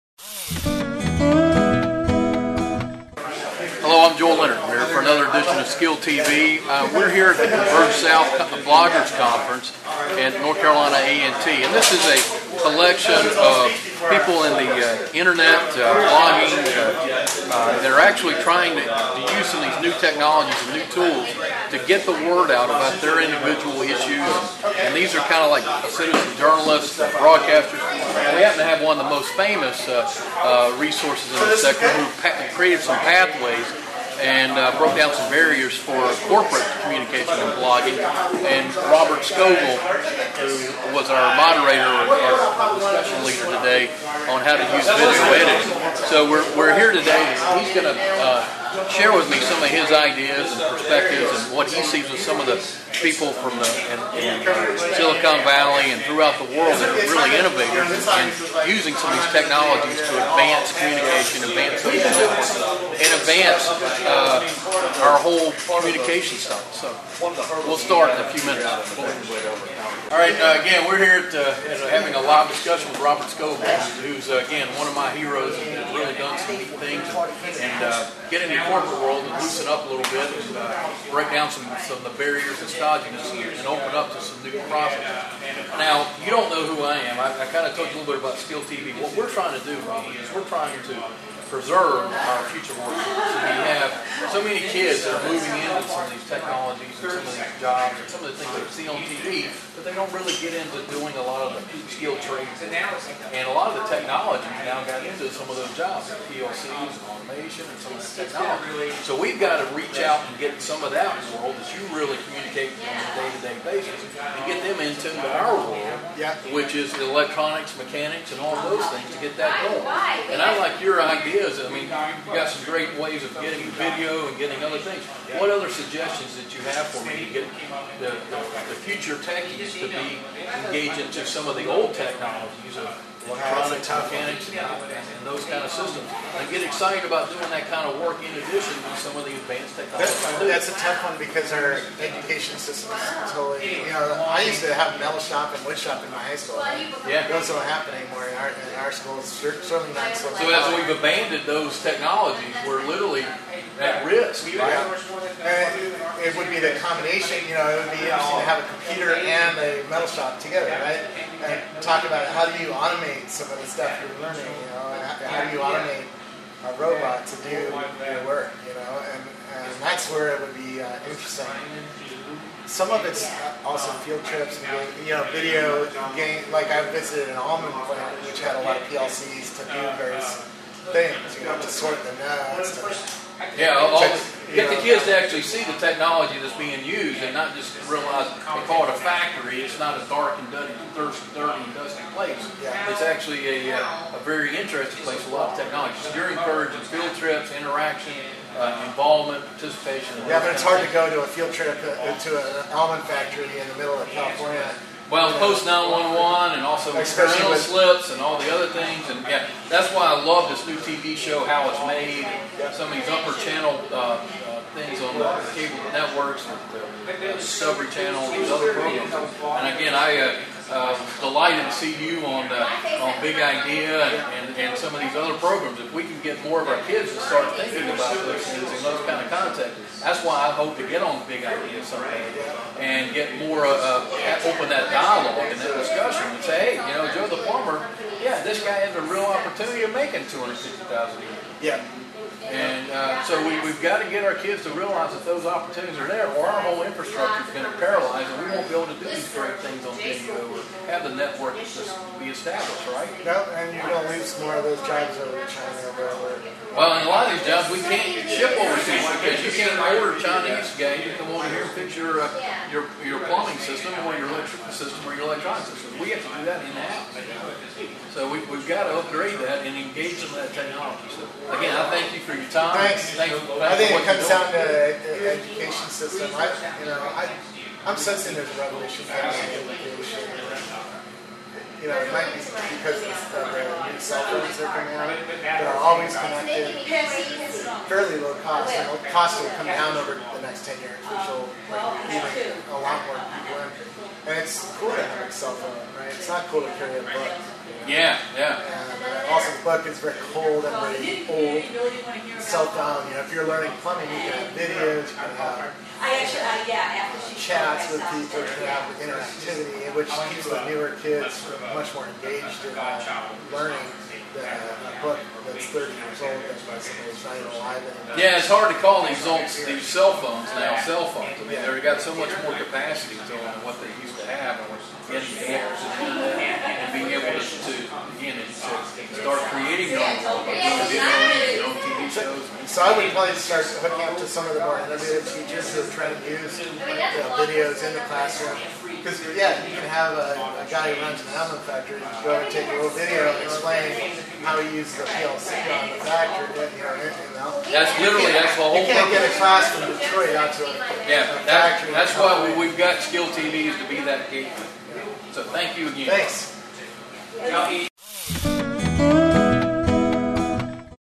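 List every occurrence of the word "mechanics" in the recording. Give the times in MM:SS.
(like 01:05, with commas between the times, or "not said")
01:57, 02:13.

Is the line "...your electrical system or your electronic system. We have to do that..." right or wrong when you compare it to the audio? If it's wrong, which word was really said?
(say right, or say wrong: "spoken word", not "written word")
right.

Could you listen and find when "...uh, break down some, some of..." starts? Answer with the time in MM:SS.
01:20.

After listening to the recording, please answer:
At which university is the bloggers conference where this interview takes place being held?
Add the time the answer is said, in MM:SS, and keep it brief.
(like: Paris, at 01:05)
North Carolina A&T, at 00:10.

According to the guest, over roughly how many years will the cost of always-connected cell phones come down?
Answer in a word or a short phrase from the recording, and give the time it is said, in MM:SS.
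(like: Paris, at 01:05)
10 years, at 04:50.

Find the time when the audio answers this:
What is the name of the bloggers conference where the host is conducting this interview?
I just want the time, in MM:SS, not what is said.
00:07.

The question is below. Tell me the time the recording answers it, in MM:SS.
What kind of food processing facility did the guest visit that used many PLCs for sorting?
02:57.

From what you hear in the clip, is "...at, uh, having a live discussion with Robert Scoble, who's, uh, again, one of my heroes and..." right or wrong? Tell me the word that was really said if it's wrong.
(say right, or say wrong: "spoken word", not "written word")
right.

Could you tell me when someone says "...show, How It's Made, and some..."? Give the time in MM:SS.
03:31.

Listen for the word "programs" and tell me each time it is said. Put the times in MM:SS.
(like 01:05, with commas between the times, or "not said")
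03:38, 03:45.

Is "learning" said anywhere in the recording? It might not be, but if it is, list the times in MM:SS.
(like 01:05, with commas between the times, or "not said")
02:44, 05:03, 05:13.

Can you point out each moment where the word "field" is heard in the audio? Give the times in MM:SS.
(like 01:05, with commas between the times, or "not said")
02:54, 03:16, 03:21.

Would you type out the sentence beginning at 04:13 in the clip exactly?
Yep, and you're going to lose more of those jobs over to China.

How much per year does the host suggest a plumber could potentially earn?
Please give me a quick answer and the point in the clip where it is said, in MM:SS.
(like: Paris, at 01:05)
$250,000, at 04:00.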